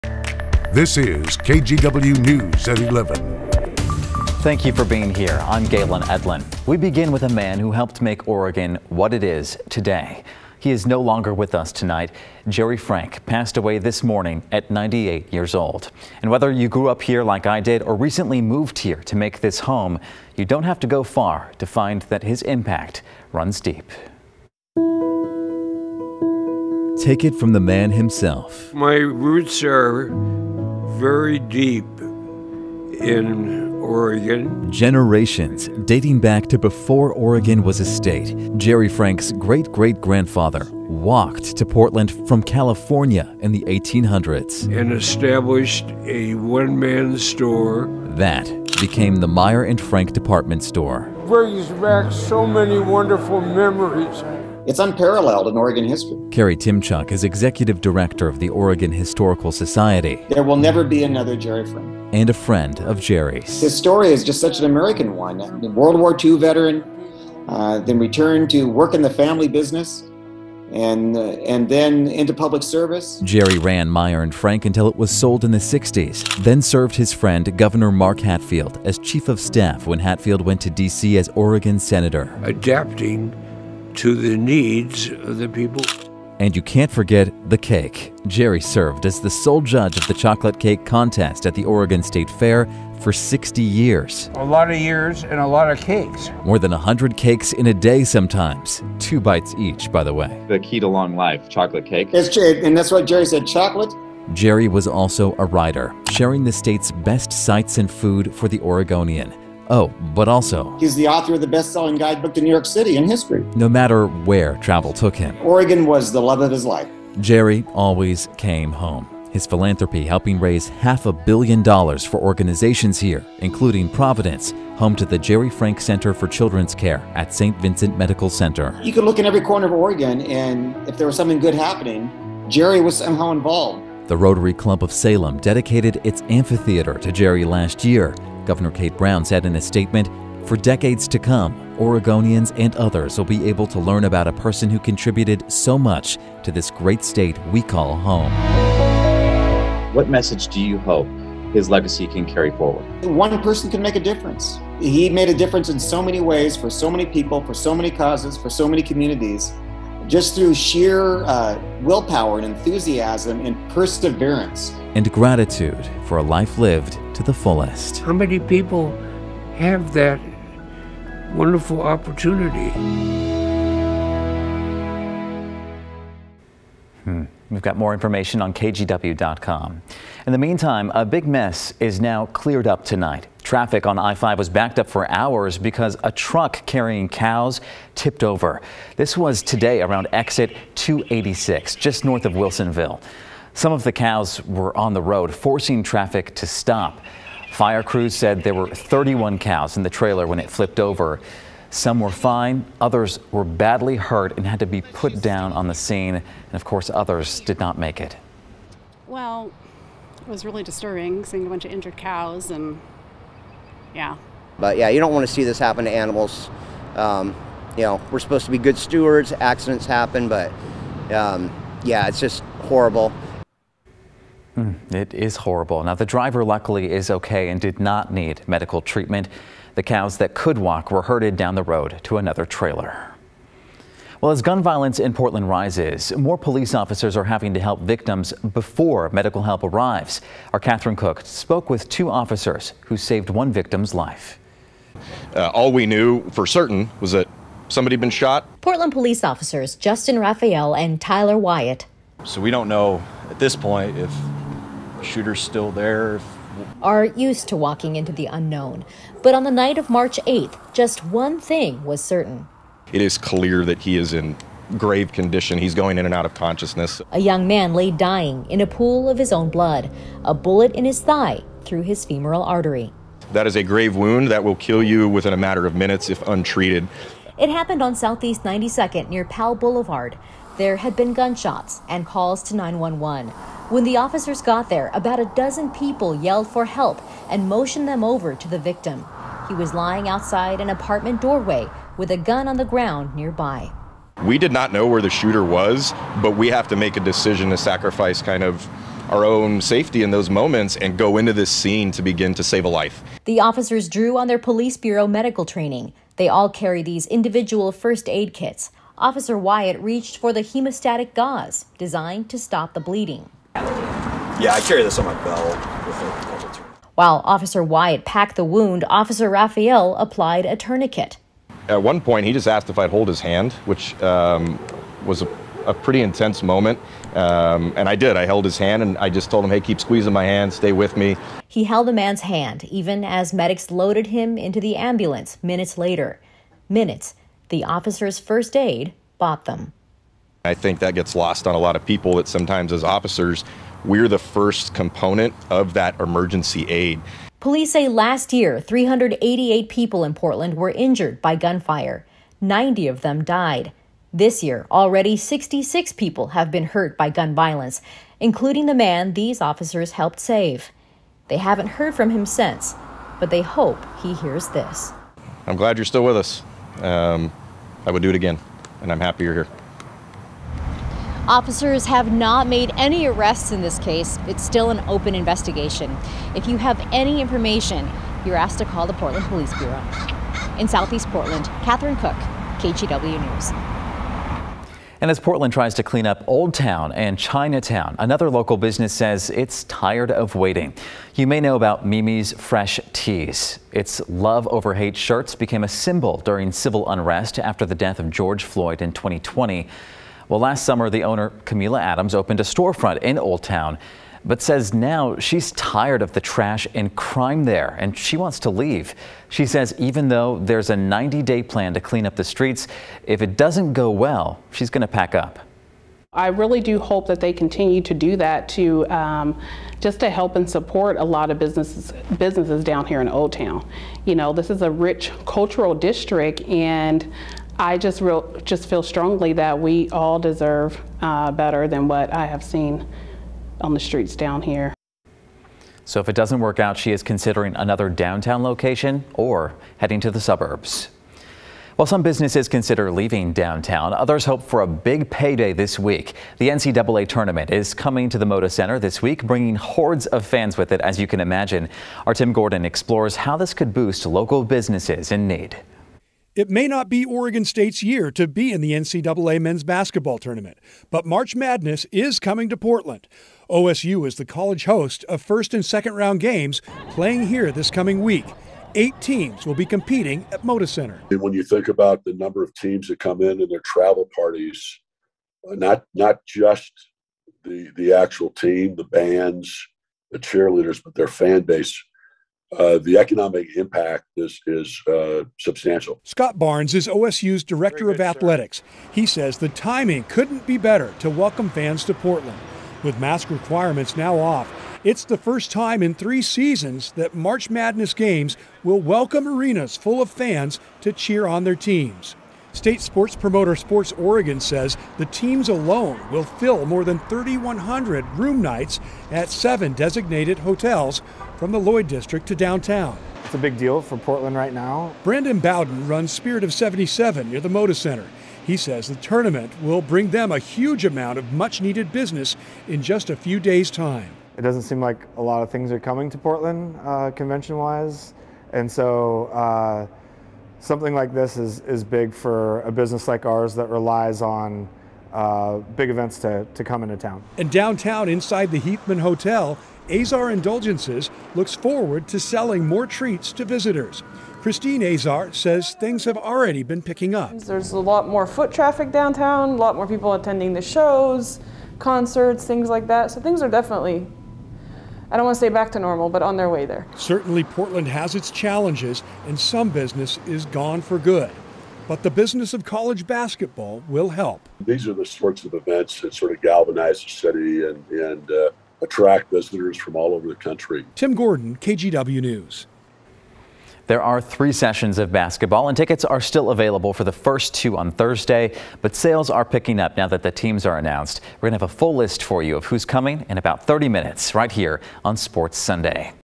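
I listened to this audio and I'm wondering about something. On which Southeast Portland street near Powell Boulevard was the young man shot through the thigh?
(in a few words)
Southeast 92nd.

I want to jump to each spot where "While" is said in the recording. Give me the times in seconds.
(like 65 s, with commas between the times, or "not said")
316 s, 441 s.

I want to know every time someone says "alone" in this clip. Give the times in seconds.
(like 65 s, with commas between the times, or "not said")
505 s.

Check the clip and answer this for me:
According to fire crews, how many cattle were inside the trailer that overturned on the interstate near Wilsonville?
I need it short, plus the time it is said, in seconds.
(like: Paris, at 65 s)
31, at 198 s.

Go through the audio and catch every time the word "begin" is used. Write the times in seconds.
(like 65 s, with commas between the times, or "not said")
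6 s, 302 s.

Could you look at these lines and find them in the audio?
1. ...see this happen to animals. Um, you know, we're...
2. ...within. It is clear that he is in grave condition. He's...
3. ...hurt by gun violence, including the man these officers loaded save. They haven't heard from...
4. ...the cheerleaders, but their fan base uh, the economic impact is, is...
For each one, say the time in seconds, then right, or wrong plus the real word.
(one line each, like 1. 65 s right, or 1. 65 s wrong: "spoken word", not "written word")
1. 215 s right
2. 262 s wrong: "certain", not "within"
3. 356 s wrong: "helped", not "loaded"
4. 480 s right.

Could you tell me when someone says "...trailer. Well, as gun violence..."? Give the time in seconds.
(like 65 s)
232 s.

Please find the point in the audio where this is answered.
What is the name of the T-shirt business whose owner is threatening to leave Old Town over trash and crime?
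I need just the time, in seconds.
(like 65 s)
391 s.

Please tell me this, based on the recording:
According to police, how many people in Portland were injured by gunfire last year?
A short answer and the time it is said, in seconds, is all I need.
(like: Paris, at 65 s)
388, at 348 s.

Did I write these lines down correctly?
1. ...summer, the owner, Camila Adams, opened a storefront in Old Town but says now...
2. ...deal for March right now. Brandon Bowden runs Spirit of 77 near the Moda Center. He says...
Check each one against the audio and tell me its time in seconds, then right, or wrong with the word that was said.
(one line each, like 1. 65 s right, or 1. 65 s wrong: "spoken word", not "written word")
1. 400 s right
2. 513 s wrong: "Portland", not "March".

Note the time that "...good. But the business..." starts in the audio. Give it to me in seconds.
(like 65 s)
560 s.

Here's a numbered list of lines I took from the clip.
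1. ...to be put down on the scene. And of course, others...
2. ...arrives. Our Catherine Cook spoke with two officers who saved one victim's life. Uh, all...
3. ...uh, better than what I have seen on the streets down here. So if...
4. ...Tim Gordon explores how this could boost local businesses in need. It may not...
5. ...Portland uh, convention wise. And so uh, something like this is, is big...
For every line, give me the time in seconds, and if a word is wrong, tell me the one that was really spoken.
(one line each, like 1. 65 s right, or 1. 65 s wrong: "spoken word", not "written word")
1. 204 s right
2. 239 s right
3. 431 s right
4. 452 s right
5. 526 s right.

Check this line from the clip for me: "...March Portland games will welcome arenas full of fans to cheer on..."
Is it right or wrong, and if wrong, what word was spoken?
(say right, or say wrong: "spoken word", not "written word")
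wrong: "Madness", not "Portland".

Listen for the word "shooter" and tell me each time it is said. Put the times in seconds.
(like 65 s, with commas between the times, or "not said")
255 s, 295 s.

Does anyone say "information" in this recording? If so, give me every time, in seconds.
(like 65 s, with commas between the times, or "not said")
177 s, 377 s.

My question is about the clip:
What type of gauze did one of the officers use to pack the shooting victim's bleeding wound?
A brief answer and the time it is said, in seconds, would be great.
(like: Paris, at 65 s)
Hemostatic gauze, at 310 s.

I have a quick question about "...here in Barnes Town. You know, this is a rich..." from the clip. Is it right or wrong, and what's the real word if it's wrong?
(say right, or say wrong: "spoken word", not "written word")
wrong: "Old", not "Barnes".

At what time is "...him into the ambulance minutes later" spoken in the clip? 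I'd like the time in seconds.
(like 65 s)
334 s.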